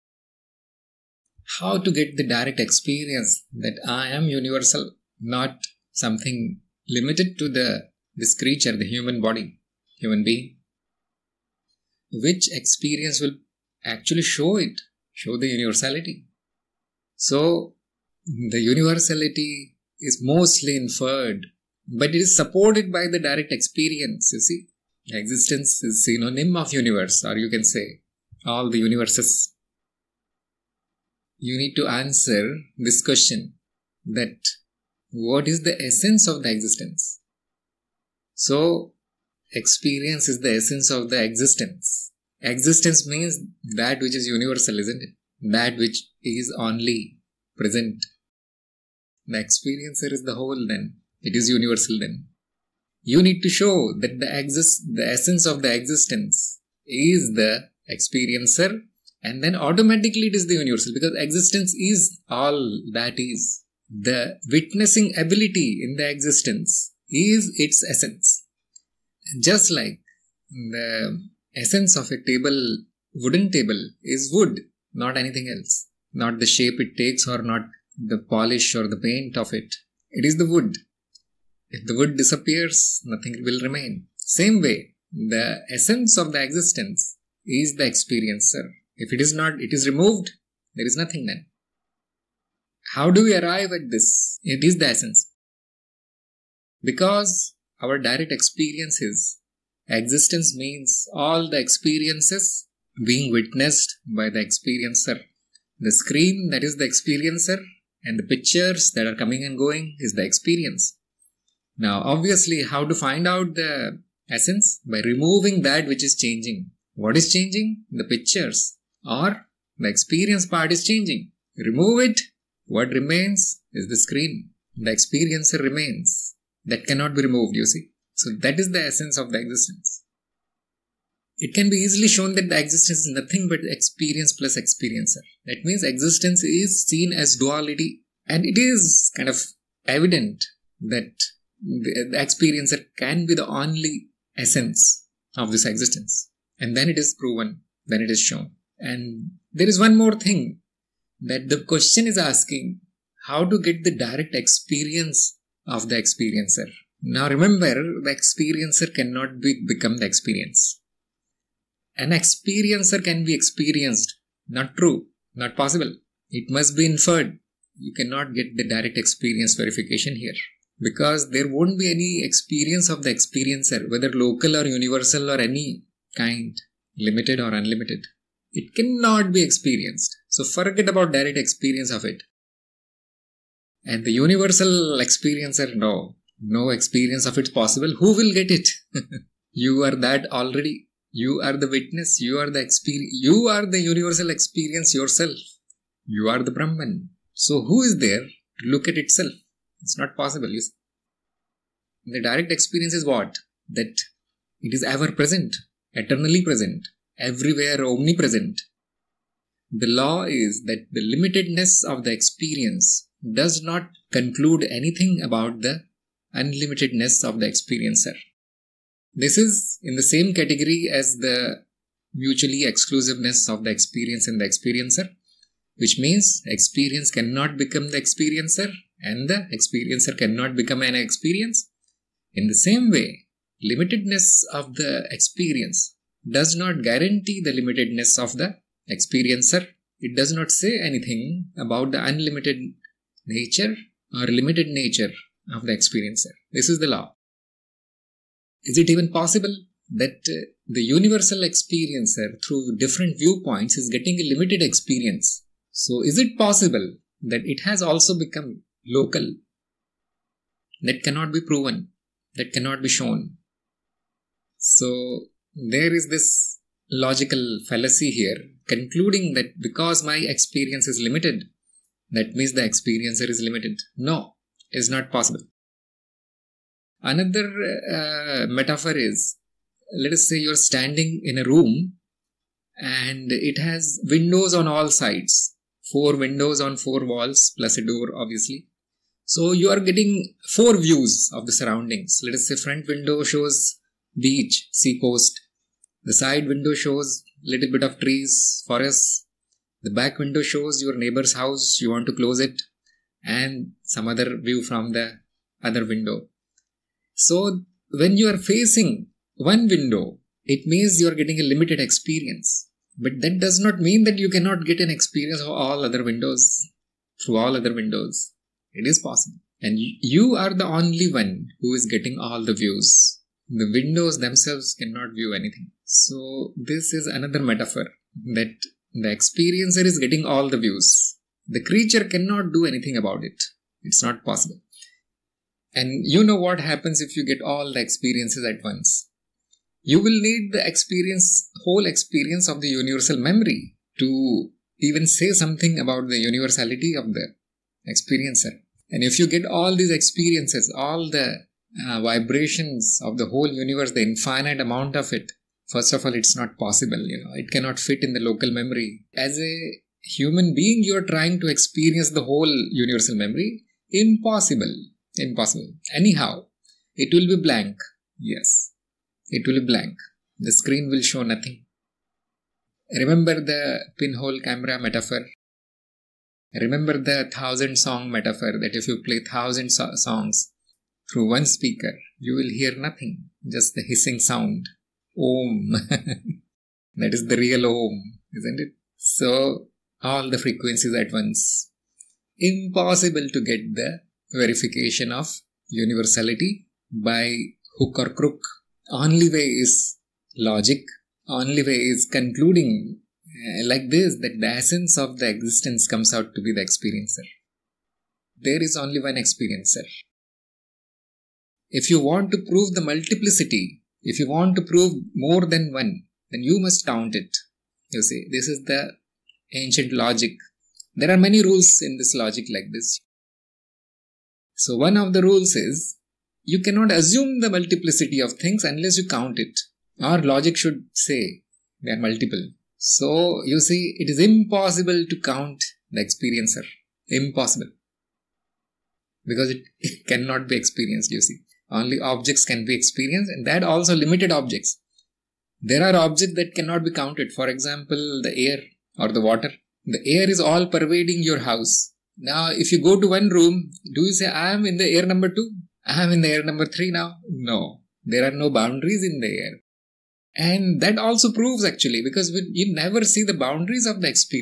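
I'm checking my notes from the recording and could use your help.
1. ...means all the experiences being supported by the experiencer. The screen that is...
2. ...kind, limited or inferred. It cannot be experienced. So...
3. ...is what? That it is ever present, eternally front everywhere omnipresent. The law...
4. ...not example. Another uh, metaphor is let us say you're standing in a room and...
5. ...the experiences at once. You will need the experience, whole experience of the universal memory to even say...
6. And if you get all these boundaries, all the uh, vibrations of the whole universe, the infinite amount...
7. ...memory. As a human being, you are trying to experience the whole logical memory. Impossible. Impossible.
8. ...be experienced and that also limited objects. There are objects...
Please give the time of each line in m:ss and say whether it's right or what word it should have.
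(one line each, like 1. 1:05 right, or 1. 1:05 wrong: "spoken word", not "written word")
1. 1:40 wrong: "witnessed", not "supported"
2. 2:56 wrong: "unlimited", not "inferred"
3. 3:22 wrong: "present", not "front"
4. 4:34 wrong: "possible", not "example"
5. 5:37 right
6. 5:48 wrong: "experiences", not "boundaries"
7. 5:58 wrong: "universal", not "logical"
8. 7:22 right.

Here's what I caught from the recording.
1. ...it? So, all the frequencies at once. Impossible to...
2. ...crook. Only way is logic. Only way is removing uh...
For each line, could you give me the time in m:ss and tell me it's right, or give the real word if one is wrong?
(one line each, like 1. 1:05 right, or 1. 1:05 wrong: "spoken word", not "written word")
1. 6:28 right
2. 6:38 wrong: "concluding", not "removing".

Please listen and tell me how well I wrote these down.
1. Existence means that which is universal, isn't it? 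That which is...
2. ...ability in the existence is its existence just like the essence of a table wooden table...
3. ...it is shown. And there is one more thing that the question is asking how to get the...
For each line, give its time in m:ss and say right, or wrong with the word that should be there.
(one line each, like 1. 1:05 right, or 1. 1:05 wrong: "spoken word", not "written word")
1. 0:42 right
2. 1:05 wrong: "essence", not "existence"
3. 2:28 right.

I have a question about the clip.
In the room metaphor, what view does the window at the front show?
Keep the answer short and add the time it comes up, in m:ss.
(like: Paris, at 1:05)
beach, sea coast, at 4:54.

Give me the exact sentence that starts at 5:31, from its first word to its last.
The creature cannot do anything about it.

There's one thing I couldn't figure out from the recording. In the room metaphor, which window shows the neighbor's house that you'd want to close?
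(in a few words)
back window.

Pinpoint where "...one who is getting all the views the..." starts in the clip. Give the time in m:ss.
5:21.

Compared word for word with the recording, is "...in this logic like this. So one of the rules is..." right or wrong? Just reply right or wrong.
right.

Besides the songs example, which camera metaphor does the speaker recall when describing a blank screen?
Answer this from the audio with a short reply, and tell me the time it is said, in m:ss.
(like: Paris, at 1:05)
pinhole camera, at 6:13.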